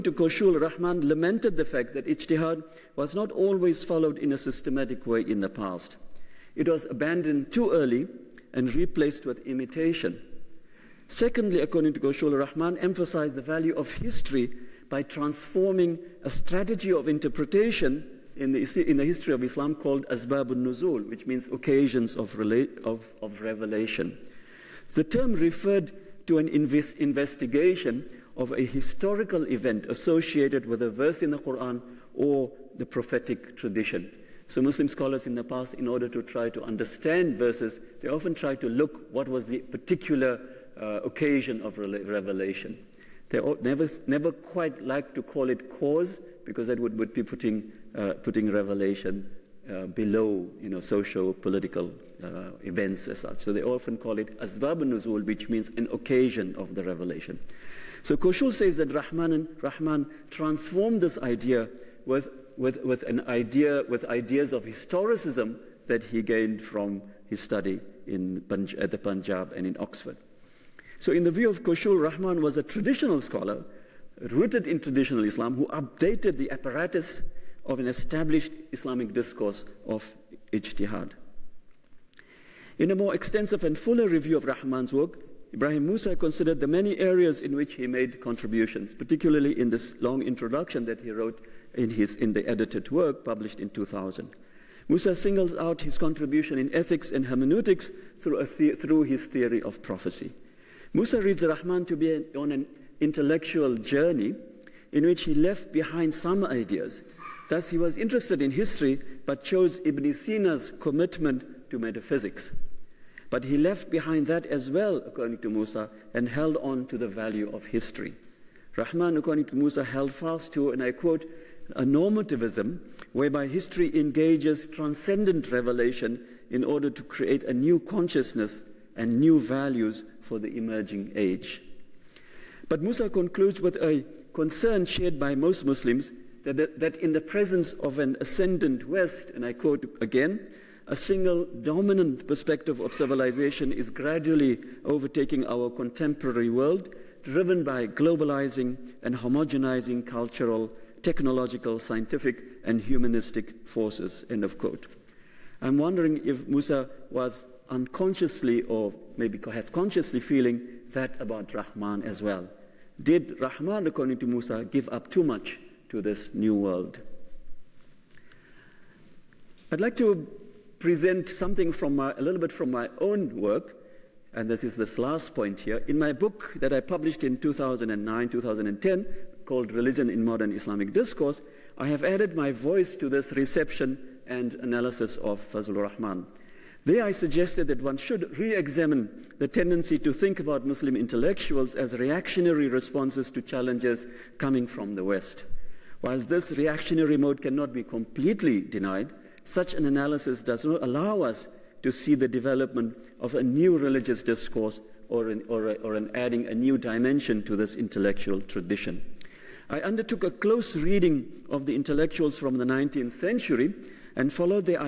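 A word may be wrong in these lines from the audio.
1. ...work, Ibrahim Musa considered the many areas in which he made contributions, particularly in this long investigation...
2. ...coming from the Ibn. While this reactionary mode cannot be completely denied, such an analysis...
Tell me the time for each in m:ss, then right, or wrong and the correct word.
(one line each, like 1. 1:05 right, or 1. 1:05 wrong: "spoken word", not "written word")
1. 1:24 wrong: "introduction", not "investigation"
2. 3:14 wrong: "West", not "Ibn".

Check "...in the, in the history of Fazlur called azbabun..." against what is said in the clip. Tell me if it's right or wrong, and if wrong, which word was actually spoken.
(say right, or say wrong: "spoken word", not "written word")
wrong: "Islam", not "Fazlur".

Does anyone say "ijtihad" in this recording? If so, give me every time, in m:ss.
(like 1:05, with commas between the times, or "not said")
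0:02, 1:20.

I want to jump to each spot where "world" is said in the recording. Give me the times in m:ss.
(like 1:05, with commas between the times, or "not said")
2:26, 2:46.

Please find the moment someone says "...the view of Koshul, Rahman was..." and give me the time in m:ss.
1:11.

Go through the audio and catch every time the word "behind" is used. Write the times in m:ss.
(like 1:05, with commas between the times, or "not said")
1:45, 1:53.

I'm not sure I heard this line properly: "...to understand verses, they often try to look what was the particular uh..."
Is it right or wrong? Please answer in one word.
right.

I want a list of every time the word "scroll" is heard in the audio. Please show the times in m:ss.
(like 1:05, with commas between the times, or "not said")
not said.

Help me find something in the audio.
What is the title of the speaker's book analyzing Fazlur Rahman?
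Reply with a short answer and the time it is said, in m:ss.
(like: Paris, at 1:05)
Religion in Modern Islamic Discourse, at 2:59.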